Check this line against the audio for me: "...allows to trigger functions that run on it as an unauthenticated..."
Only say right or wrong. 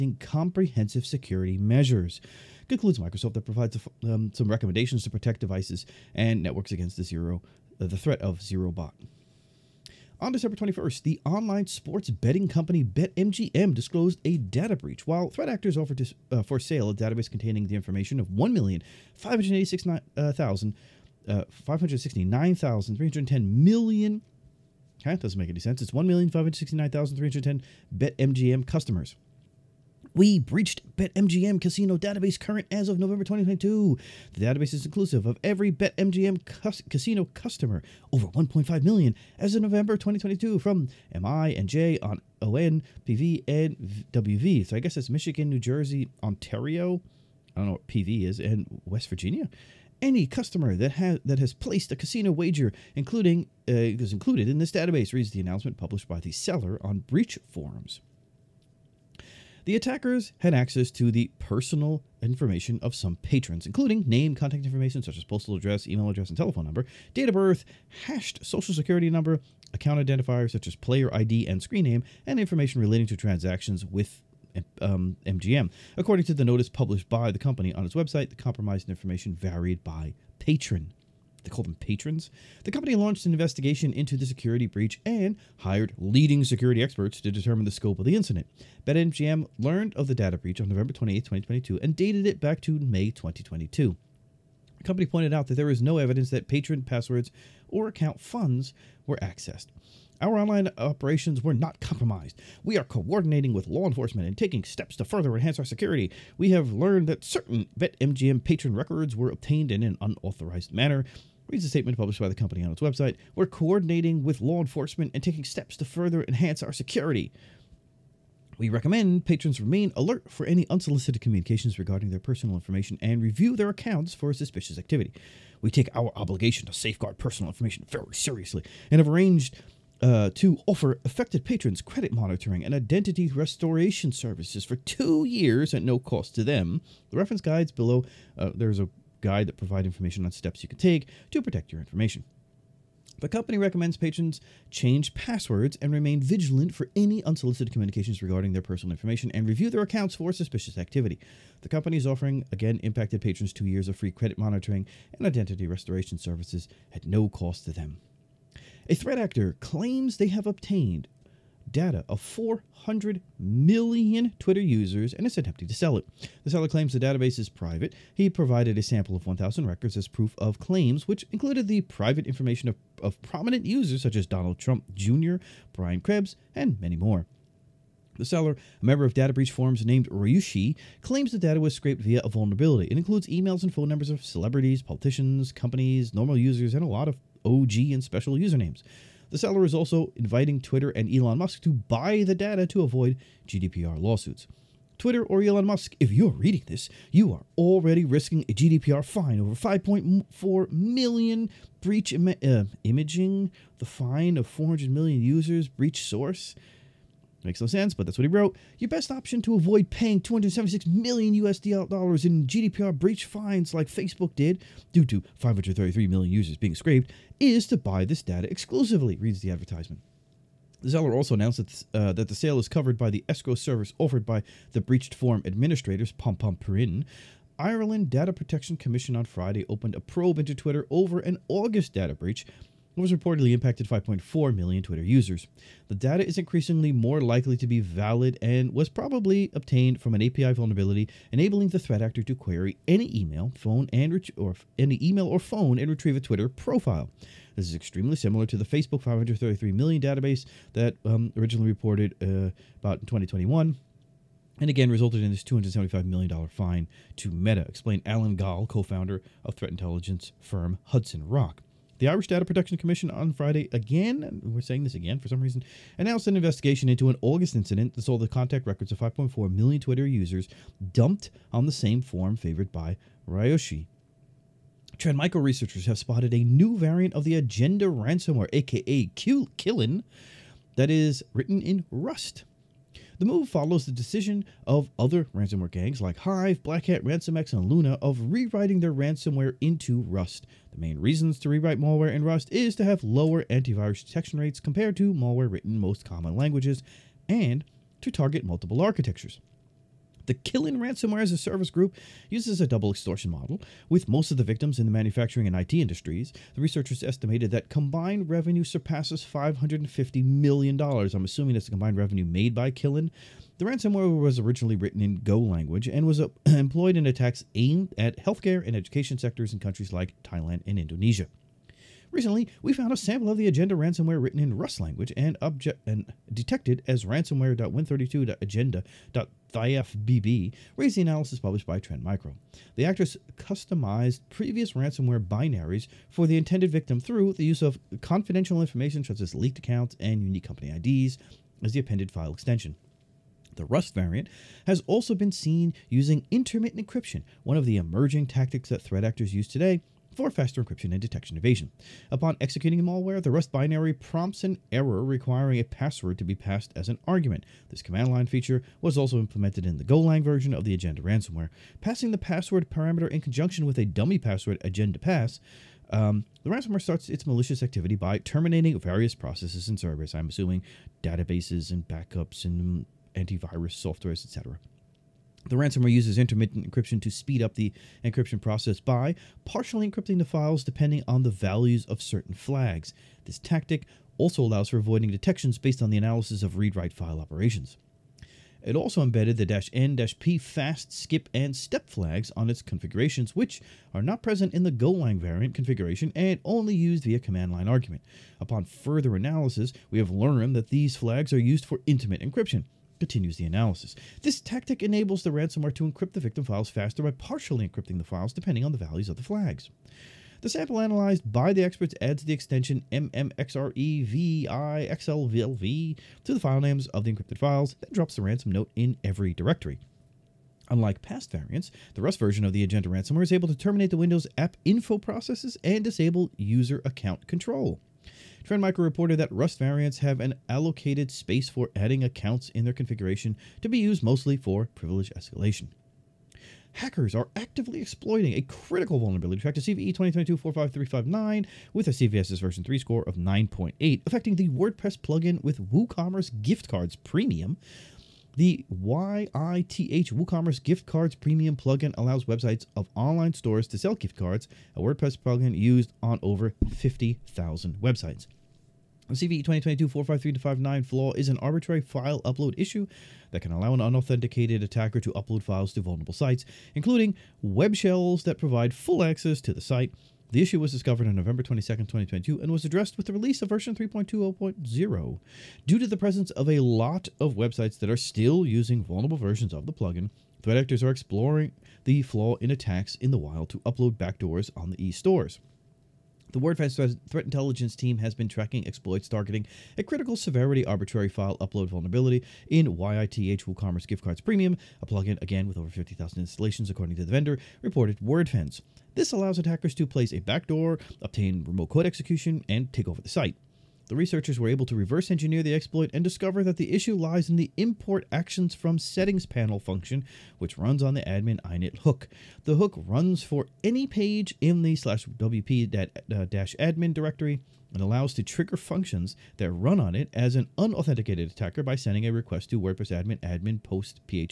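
right.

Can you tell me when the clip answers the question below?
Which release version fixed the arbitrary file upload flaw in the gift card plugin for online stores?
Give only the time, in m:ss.
7:53.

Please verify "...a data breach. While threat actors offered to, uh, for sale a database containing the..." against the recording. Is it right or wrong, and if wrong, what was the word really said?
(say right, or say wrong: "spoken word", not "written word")
right.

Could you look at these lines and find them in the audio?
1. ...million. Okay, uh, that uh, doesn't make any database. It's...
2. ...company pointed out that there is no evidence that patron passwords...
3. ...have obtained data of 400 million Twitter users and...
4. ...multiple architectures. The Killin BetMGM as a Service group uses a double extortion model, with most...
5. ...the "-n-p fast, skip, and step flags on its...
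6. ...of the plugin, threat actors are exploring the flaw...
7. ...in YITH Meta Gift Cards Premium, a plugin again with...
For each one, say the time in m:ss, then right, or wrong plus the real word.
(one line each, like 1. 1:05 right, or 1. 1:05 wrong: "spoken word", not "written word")
1. 0:23 wrong: "sense", not "database"
2. 1:34 right
3. 2:40 right
4. 4:58 wrong: "Ransomware", not "BetMGM"
5. 6:29 right
6. 7:59 right
7. 8:12 wrong: "WooCommerce", not "Meta".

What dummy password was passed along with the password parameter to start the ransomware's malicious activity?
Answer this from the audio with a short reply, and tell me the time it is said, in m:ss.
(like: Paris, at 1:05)
Agenda pass, at 6:04.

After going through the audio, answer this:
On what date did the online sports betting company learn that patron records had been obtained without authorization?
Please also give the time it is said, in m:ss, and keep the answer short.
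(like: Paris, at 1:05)
November 28, 2022, at 1:30.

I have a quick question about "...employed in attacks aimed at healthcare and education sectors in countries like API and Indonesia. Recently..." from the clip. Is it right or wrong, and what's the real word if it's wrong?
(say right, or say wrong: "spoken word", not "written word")
wrong: "Thailand", not "API".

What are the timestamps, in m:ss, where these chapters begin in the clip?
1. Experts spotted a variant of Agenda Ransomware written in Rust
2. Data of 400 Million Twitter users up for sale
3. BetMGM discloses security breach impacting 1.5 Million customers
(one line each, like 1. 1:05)
1. 4:35
2. 2:37
3. 0:08.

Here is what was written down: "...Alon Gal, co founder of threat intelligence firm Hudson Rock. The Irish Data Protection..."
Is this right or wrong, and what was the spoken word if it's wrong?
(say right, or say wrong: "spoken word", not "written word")
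right.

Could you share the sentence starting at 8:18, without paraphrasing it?
This allows attackers to place a backdoor, obtain remote code execution, and take over the site.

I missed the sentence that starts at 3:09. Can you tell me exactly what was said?
The seller is also inviting Twitter and Elon Musk to buy the data to avoid GDPR lawsuits.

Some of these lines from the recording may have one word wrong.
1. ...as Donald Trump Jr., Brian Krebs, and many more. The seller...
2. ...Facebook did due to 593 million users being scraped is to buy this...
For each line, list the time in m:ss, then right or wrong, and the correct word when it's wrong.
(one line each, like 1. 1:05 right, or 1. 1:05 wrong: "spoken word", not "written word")
1. 2:54 right
2. 3:33 wrong: "533", not "593".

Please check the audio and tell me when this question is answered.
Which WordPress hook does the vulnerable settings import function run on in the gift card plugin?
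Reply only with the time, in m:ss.
8:31.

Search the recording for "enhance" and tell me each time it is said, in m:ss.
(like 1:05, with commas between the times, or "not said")
1:45, 1:56.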